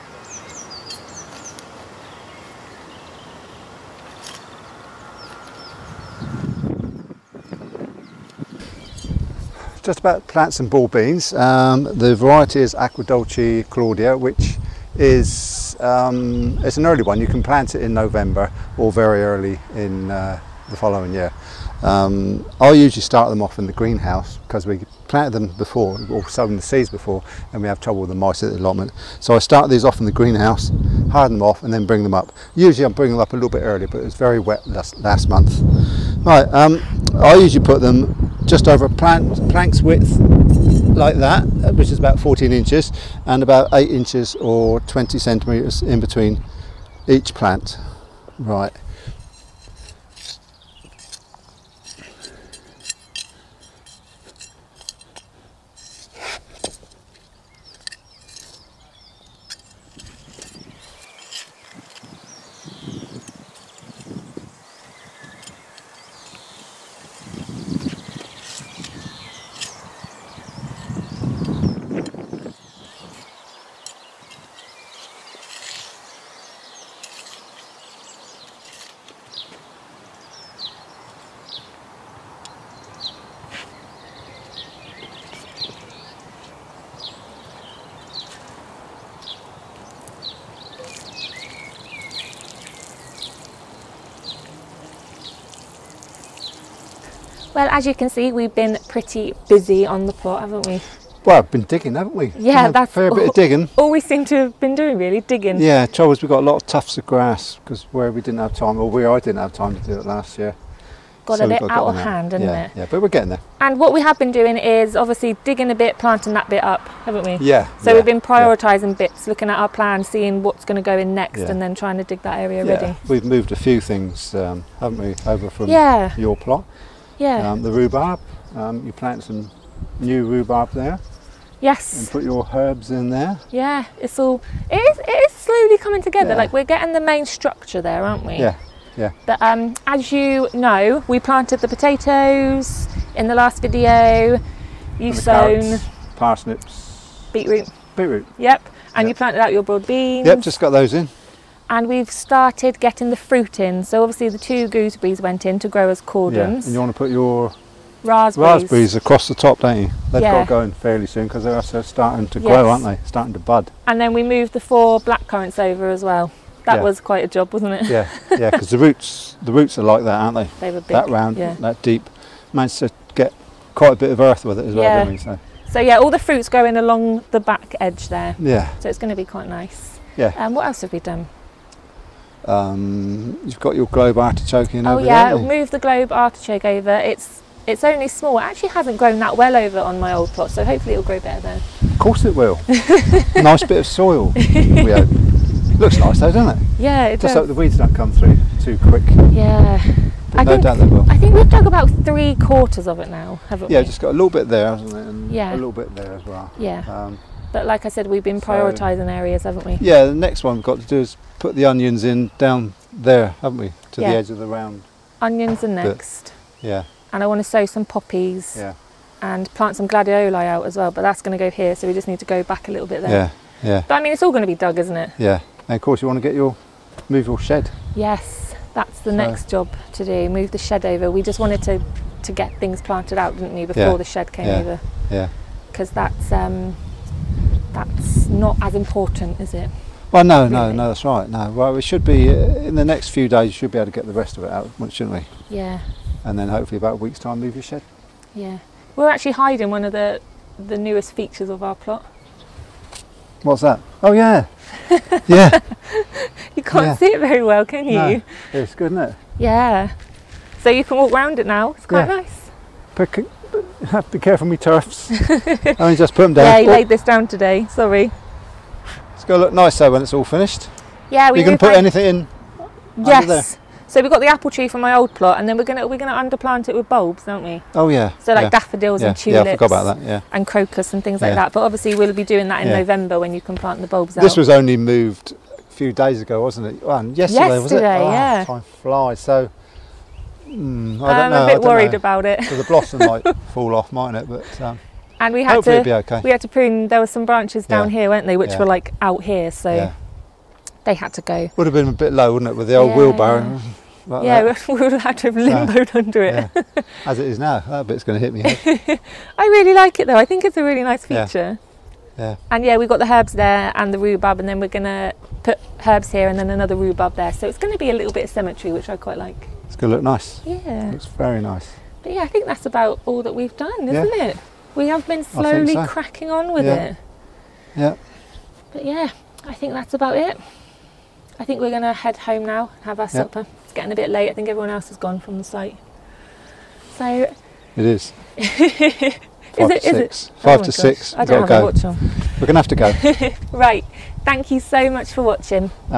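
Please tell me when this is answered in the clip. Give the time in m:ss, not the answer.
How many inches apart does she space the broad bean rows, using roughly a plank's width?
0:42.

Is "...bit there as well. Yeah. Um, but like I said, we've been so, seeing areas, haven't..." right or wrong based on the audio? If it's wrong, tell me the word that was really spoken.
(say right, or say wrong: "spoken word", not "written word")
wrong: "prioritising", not "seeing".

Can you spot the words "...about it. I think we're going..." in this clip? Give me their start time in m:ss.
5:29.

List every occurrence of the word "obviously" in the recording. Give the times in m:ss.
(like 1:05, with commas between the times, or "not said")
1:54, 2:34, 4:41.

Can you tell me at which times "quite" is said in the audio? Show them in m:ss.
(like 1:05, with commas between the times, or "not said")
2:46, 2:53, 2:59, 4:21, 5:18.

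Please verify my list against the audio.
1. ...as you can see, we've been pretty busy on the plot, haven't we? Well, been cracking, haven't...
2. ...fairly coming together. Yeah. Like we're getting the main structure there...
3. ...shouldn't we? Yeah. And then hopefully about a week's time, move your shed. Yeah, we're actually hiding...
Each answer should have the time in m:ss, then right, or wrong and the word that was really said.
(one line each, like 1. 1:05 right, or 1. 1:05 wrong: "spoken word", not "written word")
1. 1:37 wrong: "digging", not "cracking"
2. 2:15 wrong: "slowly", not "fairly"
3. 4:04 right.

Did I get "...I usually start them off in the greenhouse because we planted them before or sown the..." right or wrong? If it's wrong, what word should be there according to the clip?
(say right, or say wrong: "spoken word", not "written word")
right.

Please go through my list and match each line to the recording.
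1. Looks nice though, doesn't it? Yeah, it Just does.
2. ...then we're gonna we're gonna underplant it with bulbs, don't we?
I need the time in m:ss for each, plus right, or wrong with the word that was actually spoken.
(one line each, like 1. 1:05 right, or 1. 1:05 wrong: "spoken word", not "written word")
1. 3:15 right
2. 4:35 right.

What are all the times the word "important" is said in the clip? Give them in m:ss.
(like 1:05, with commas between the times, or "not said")
3:58.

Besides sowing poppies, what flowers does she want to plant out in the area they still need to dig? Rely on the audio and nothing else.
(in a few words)
Gladioli.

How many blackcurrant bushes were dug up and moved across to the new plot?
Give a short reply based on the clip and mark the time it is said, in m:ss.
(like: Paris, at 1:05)
4, at 2:44.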